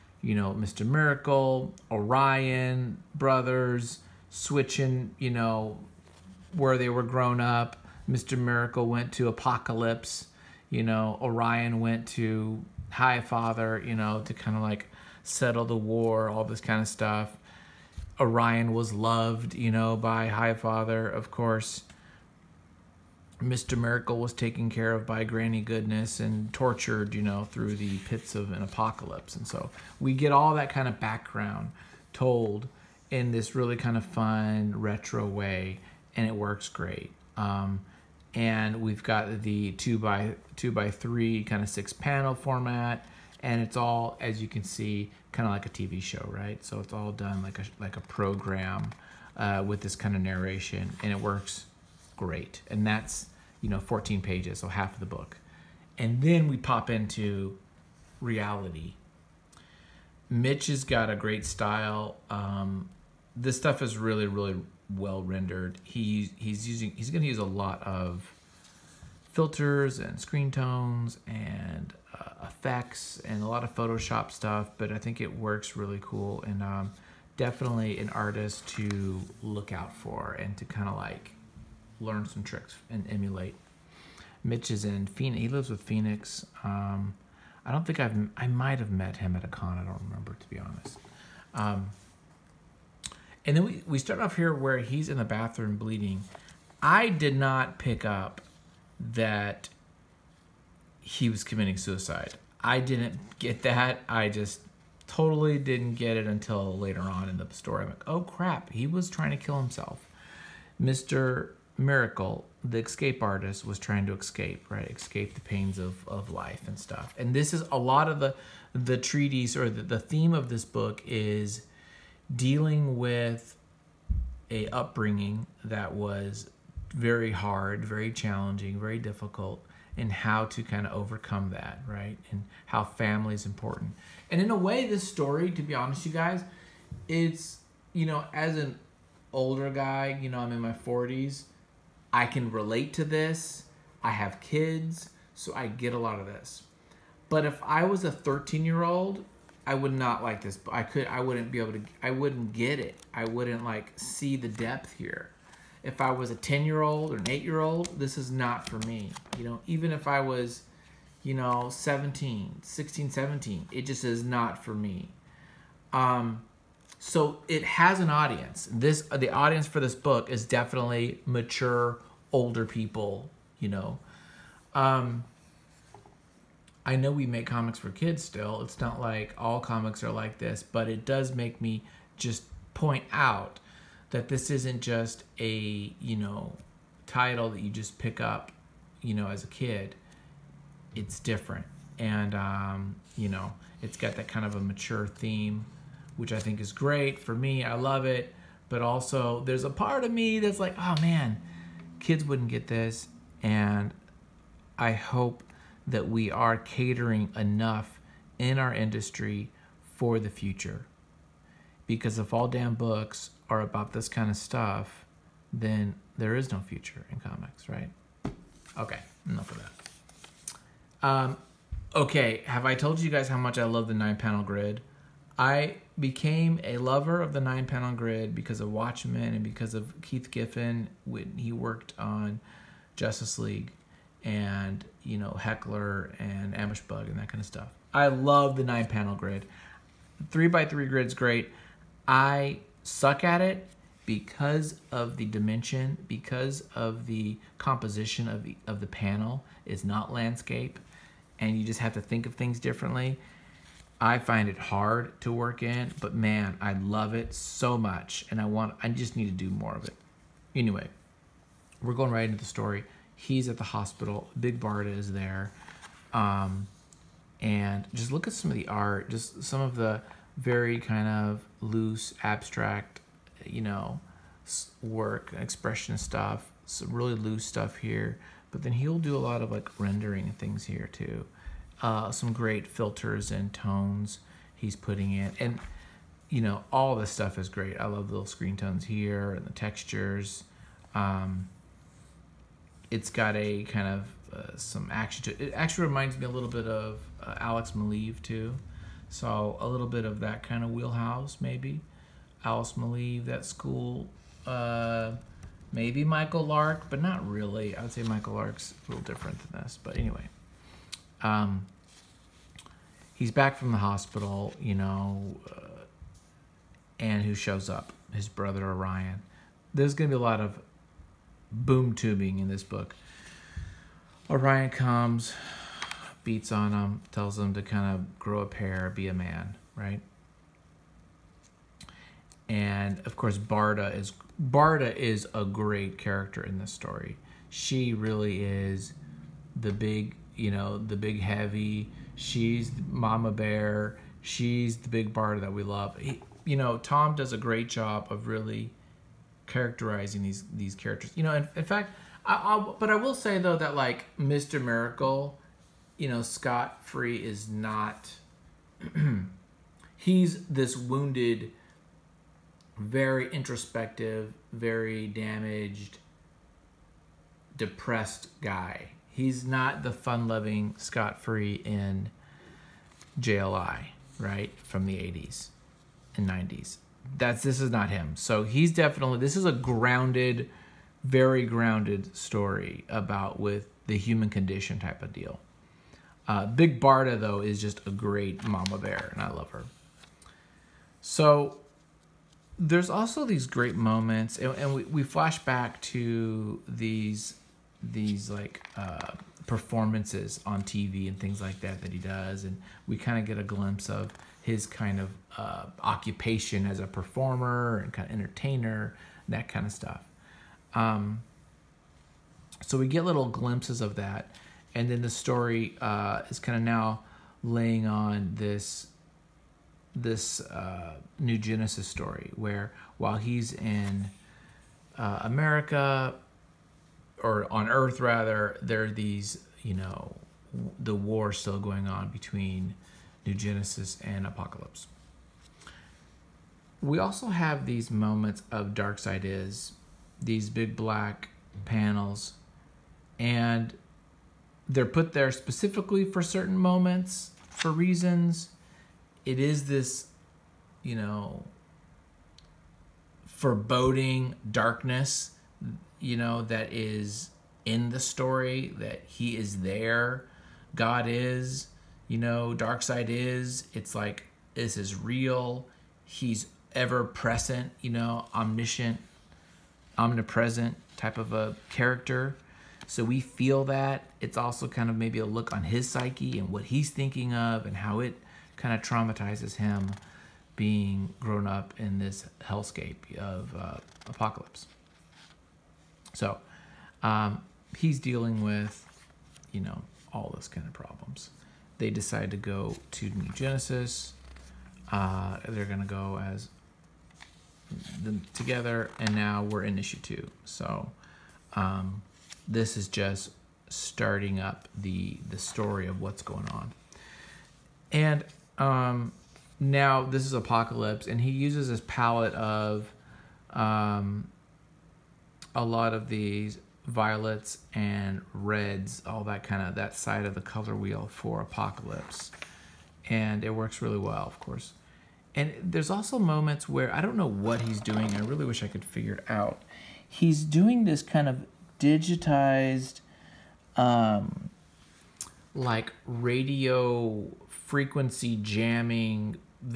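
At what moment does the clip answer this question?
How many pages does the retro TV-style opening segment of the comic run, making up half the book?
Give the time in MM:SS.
00:53.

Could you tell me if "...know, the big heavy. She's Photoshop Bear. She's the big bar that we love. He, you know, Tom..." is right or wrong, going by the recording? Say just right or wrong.
wrong.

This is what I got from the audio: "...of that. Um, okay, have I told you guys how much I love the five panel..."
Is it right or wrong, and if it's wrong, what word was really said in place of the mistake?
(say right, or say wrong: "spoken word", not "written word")
wrong: "nine", not "five".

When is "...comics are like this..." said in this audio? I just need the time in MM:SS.
02:59.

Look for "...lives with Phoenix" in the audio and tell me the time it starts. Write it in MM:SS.
01:25.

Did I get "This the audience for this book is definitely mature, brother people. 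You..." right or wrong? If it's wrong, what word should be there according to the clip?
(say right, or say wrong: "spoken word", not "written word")
wrong: "older", not "brother".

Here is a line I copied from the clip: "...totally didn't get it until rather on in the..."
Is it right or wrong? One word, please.
wrong.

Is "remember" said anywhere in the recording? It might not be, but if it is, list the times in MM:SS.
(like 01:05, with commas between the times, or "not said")
01:30.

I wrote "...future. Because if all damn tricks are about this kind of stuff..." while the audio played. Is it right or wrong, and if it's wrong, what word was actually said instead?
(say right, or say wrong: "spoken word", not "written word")
wrong: "books", not "tricks".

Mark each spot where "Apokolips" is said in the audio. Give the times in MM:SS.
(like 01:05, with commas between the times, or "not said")
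00:09, 00:28, 07:14, 08:04, 08:30, 08:41.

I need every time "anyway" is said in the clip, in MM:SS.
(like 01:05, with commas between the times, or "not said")
04:20, 05:09.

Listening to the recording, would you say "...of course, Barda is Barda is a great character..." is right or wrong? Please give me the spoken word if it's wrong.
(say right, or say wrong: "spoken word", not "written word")
right.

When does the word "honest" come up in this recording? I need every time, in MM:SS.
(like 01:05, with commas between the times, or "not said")
01:30, 02:15.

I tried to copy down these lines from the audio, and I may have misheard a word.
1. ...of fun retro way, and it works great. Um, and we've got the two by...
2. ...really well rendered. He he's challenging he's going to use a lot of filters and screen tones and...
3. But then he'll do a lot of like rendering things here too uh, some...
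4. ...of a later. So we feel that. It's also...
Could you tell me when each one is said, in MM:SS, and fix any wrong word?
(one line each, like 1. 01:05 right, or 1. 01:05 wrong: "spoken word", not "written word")
1. 00:33 right
2. 01:04 wrong: "using", not "challenging"
3. 04:38 right
4. 07:51 wrong: "character", not "later".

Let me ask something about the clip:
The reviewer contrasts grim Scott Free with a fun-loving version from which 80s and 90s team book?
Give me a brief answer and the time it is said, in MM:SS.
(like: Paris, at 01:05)
JLI, at 06:13.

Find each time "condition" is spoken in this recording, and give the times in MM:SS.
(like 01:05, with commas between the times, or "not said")
06:24.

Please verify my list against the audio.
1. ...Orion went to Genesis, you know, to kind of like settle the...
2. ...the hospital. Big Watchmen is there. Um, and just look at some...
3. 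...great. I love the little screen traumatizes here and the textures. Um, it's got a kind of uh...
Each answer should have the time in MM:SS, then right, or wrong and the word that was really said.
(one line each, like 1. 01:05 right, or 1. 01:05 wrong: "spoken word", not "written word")
1. 00:11 wrong: "Highfather", not "Genesis"
2. 04:23 wrong: "Barda", not "Watchmen"
3. 04:47 wrong: "tones", not "traumatizes".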